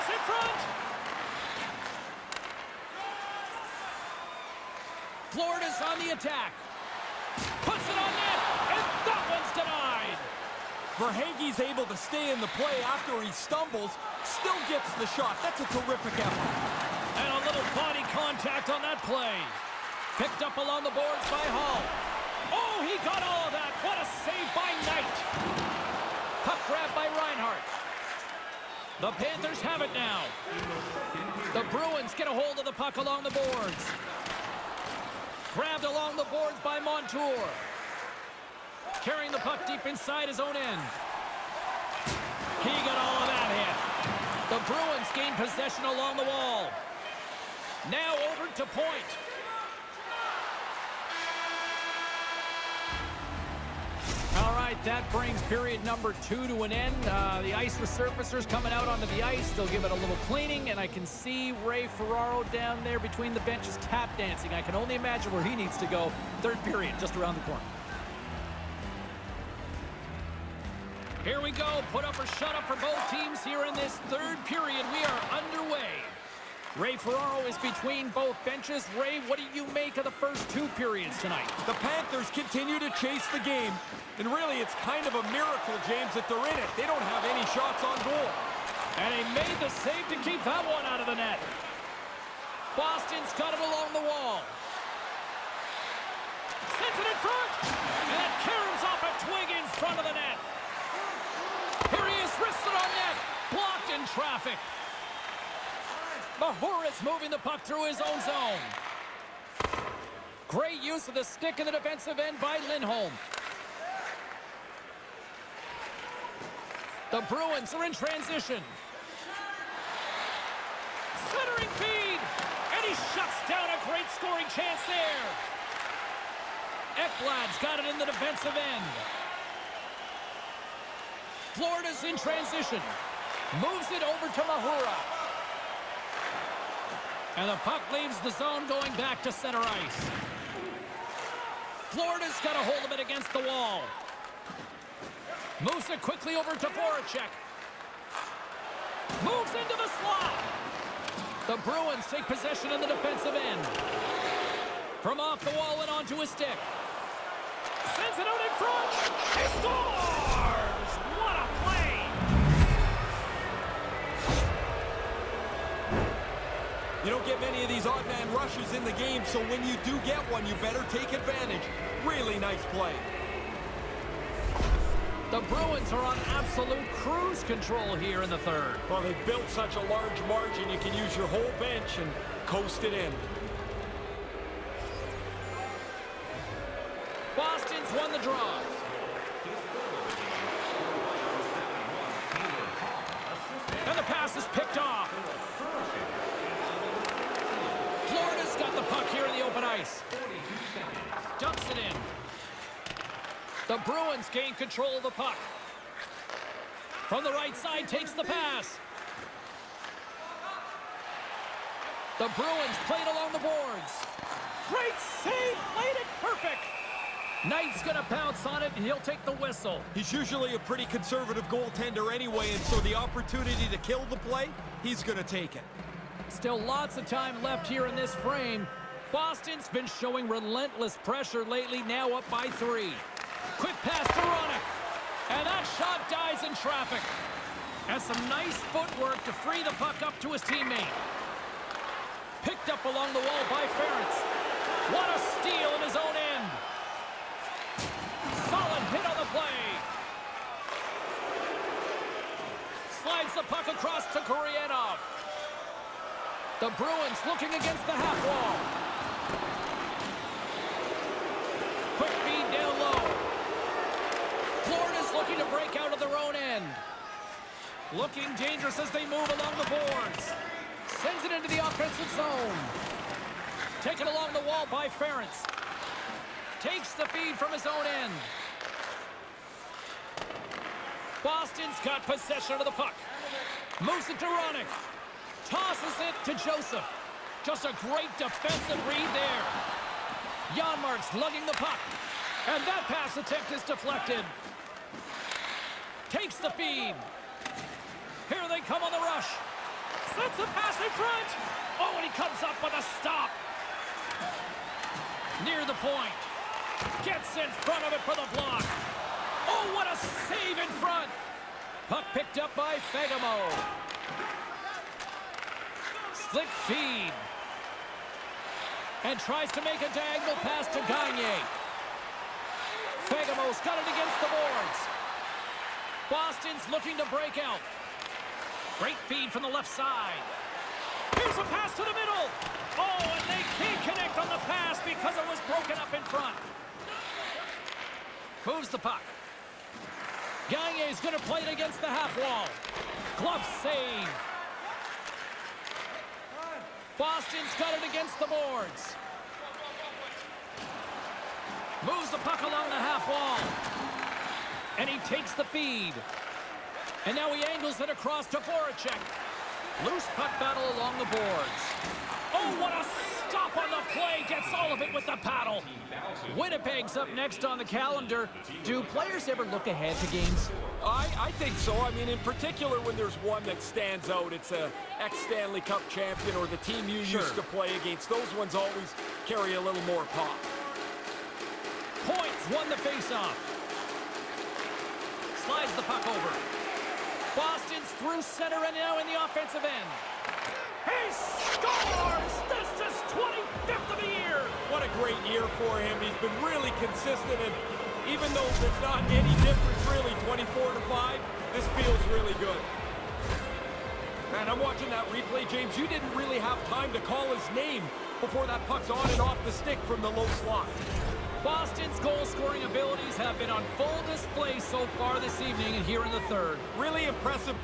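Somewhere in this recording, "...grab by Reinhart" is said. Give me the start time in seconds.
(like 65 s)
26 s.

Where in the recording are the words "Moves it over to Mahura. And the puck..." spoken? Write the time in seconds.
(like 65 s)
133 s.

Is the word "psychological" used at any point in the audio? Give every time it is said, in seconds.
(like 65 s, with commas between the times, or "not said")
not said.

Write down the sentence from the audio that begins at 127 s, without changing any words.
Ekblad's got it in the defensive end.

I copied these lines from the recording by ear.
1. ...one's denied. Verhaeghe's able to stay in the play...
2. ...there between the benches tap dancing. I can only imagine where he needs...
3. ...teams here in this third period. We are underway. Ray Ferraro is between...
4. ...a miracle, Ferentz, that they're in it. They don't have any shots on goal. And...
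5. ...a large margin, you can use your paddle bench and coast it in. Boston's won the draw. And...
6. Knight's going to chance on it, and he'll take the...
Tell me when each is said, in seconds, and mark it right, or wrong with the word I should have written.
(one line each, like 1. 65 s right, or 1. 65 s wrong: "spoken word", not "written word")
1. 9 s right
2. 62 s right
3. 73 s right
4. 85 s wrong: "James", not "Ferentz"
5. 179 s wrong: "whole", not "paddle"
6. 217 s wrong: "bounce", not "chance".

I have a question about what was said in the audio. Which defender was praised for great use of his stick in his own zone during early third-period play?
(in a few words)
Lindholm.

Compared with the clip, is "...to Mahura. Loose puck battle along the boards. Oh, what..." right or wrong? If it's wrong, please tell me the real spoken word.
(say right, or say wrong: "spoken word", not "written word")
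wrong: "Voracek", not "Mahura".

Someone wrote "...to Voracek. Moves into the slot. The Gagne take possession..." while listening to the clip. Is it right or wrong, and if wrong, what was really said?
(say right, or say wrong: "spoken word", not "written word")
wrong: "Bruins", not "Gagne".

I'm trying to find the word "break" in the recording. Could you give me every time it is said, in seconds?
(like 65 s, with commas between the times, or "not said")
265 s, 327 s.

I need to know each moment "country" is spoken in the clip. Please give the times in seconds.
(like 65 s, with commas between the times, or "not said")
not said.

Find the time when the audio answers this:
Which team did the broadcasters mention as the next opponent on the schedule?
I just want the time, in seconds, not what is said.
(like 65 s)
366 s.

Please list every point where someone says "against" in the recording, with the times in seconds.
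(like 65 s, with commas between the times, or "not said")
142 s, 257 s, 323 s, 341 s, 347 s, 377 s.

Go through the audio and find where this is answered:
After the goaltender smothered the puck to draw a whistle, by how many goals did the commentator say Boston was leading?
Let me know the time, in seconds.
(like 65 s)
232 s.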